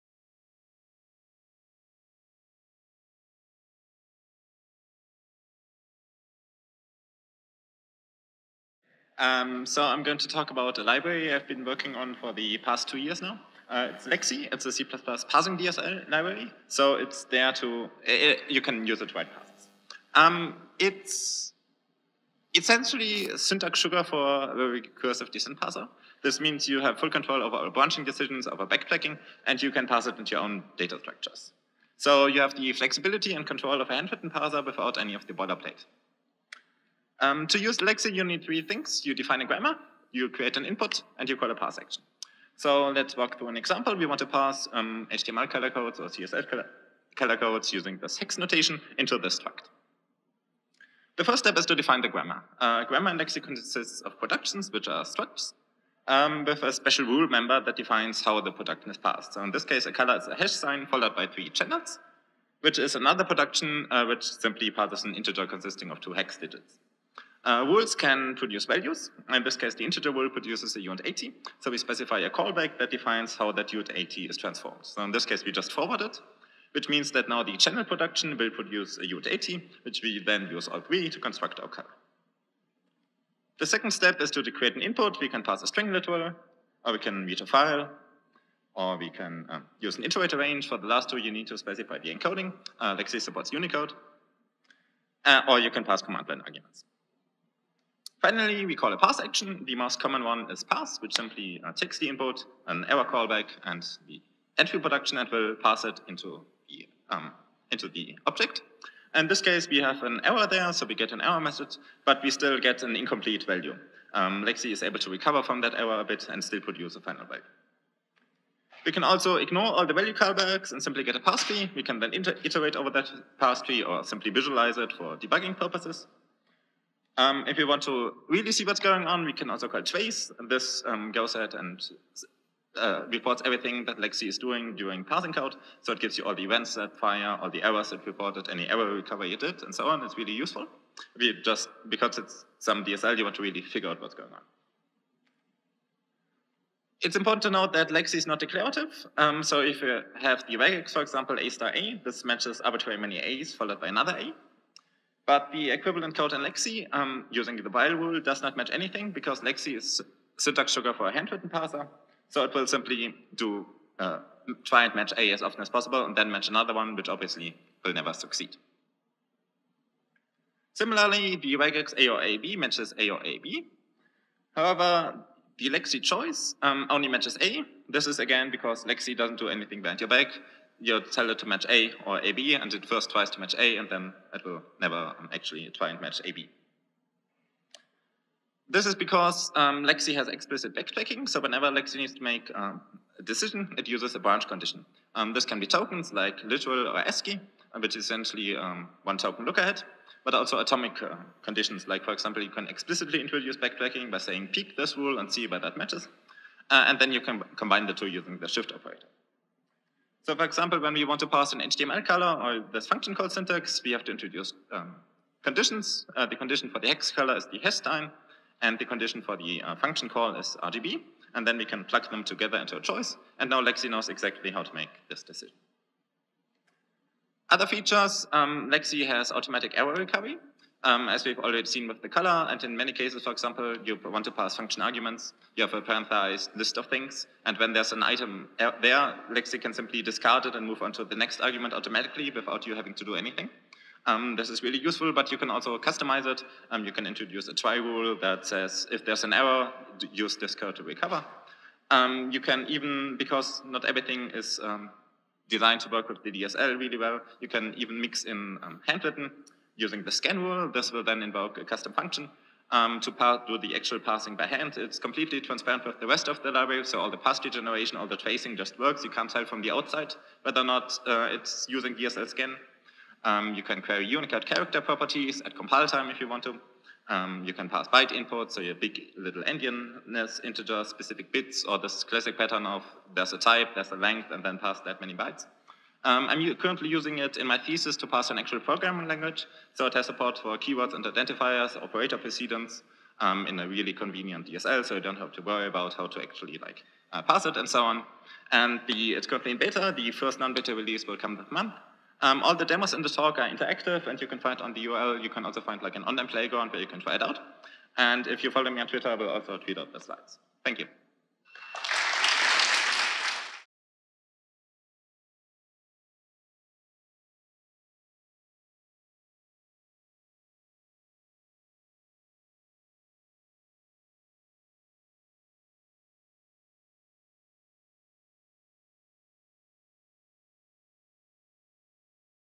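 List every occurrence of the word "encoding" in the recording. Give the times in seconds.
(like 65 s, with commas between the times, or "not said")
92 s.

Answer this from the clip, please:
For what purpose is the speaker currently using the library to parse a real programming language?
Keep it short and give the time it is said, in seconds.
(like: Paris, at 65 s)
thesis, at 287 s.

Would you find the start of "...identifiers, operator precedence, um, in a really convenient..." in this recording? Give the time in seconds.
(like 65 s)
291 s.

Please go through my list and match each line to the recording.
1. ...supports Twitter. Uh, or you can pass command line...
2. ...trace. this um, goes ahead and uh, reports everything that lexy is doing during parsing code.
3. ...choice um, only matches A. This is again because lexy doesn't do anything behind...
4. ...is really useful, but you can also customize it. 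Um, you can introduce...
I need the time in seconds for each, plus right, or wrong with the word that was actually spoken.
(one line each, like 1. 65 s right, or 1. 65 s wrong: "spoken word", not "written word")
1. 93 s wrong: "Unicode", not "Twitter"
2. 129 s right
3. 176 s right
4. 244 s right.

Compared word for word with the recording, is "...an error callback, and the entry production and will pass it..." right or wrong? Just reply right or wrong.
right.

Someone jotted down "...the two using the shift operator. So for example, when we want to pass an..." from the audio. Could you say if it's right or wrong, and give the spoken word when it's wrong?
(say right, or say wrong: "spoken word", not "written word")
right.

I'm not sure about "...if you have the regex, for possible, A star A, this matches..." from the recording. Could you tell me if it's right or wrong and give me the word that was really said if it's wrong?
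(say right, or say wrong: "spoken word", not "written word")
wrong: "example", not "possible".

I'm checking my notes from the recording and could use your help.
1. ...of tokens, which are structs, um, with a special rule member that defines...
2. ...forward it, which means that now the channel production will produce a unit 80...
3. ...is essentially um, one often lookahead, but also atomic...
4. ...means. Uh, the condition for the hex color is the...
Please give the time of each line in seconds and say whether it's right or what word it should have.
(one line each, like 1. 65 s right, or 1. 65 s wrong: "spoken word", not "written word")
1. 54 s wrong: "productions", not "tokens"
2. 75 s right
3. 197 s wrong: "token", not "often"
4. 215 s wrong: "conditions", not "means".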